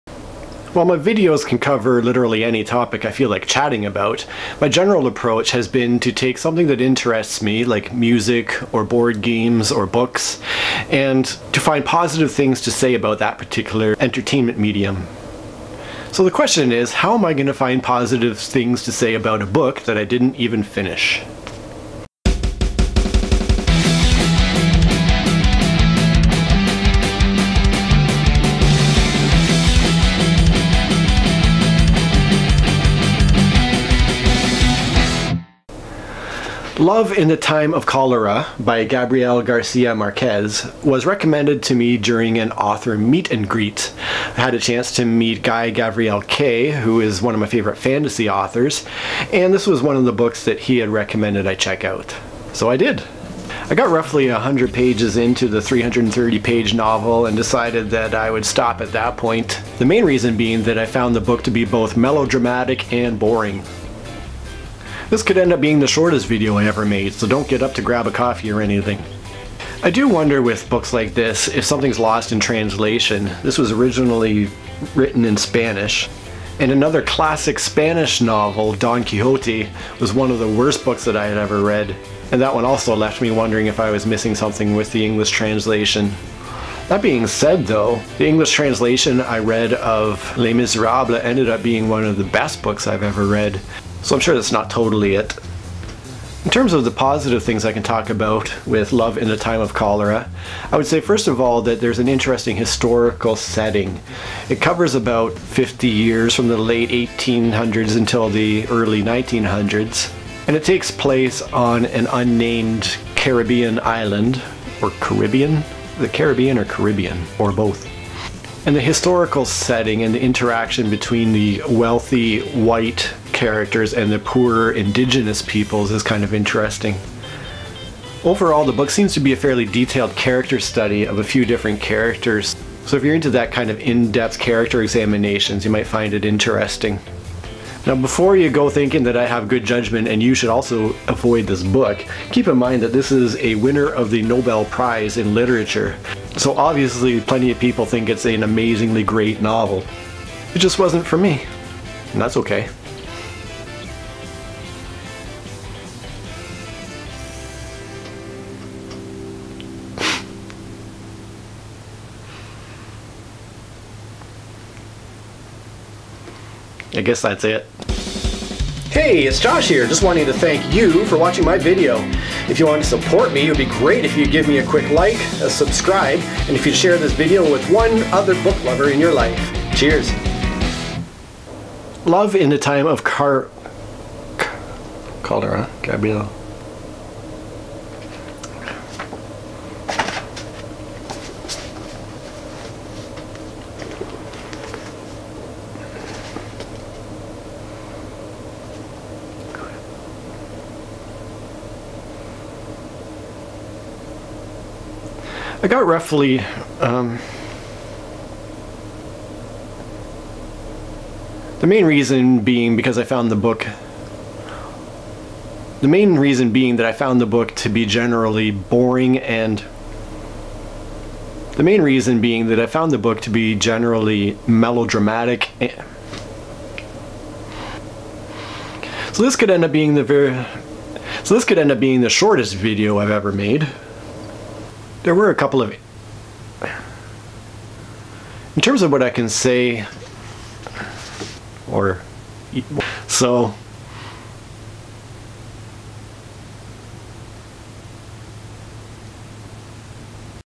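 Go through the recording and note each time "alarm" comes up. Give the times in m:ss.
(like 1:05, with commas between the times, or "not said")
not said.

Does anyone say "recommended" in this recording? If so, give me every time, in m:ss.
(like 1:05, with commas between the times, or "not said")
0:41, 0:50.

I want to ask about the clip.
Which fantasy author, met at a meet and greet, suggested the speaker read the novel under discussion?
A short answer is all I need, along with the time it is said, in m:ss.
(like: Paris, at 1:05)
Guy Gabriel Kay, at 0:45.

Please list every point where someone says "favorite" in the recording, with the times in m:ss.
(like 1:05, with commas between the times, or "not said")
0:47.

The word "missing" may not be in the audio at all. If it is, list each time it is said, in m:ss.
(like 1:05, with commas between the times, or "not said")
1:24.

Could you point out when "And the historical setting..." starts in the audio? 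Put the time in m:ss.
1:58.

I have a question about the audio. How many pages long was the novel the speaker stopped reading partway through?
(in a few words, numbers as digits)
330.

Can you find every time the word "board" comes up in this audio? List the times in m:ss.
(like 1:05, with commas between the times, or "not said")
0:08.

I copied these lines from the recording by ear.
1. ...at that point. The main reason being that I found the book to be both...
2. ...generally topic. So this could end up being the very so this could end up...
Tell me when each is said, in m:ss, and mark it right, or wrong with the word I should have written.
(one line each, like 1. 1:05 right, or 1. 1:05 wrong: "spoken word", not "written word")
1. 0:58 right
2. 3:43 wrong: "melodramatic", not "topic".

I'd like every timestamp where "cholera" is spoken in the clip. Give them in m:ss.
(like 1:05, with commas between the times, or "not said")
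0:37, 1:39.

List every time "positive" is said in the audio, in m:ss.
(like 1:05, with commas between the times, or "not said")
0:11, 0:17, 1:36.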